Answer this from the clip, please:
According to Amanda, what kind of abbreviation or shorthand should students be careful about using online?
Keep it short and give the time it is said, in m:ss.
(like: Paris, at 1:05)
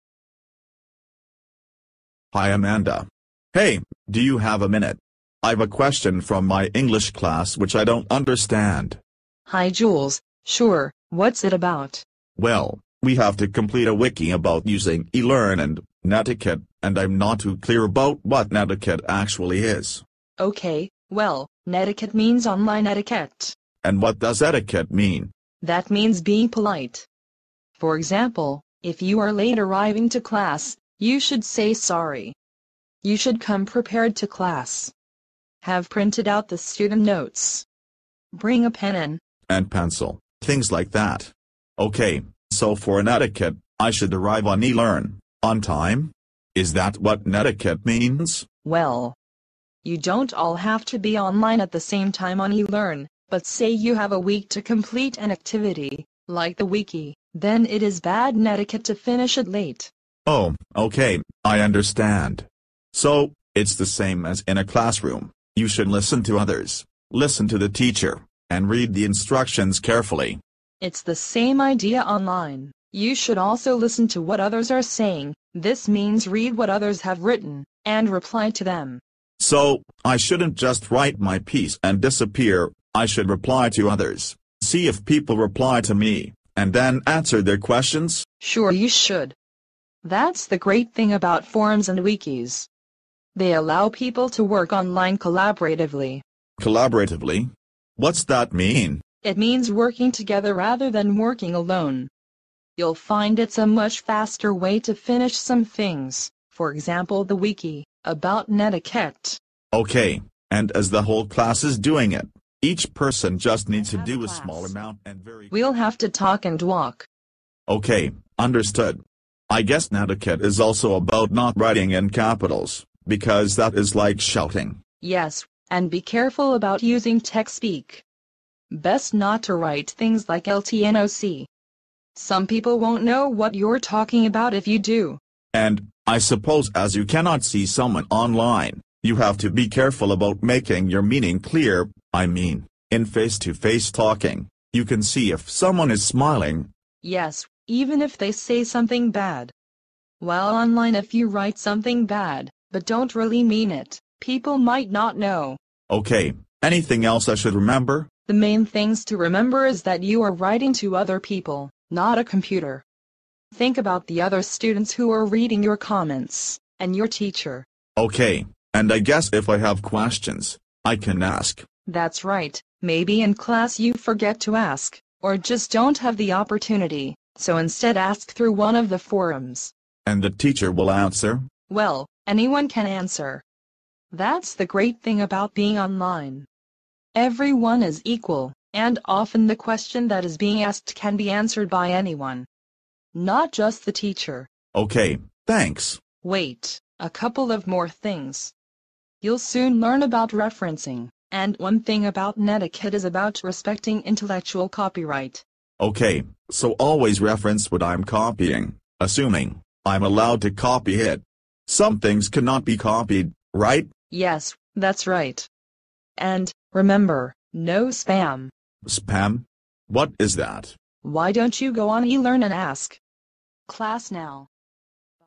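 Tech speak, at 2:07.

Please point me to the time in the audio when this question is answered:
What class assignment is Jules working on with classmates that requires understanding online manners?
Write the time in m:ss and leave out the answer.
0:13.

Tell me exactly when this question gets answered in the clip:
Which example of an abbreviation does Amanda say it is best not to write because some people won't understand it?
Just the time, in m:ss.
2:10.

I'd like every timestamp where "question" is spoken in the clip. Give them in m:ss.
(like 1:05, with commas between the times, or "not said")
0:05, 1:27, 2:49, 3:09.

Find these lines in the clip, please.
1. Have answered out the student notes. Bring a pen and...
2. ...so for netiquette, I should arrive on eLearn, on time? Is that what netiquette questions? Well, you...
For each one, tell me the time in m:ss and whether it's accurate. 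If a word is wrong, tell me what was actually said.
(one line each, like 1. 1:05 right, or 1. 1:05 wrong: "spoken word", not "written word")
1. 0:35 wrong: "printed", not "answered"
2. 0:42 wrong: "means", not "questions".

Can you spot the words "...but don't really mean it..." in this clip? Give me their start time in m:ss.
2:32.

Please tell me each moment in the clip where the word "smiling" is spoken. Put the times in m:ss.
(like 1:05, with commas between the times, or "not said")
2:26.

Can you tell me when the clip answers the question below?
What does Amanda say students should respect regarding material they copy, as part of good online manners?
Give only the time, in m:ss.
3:24.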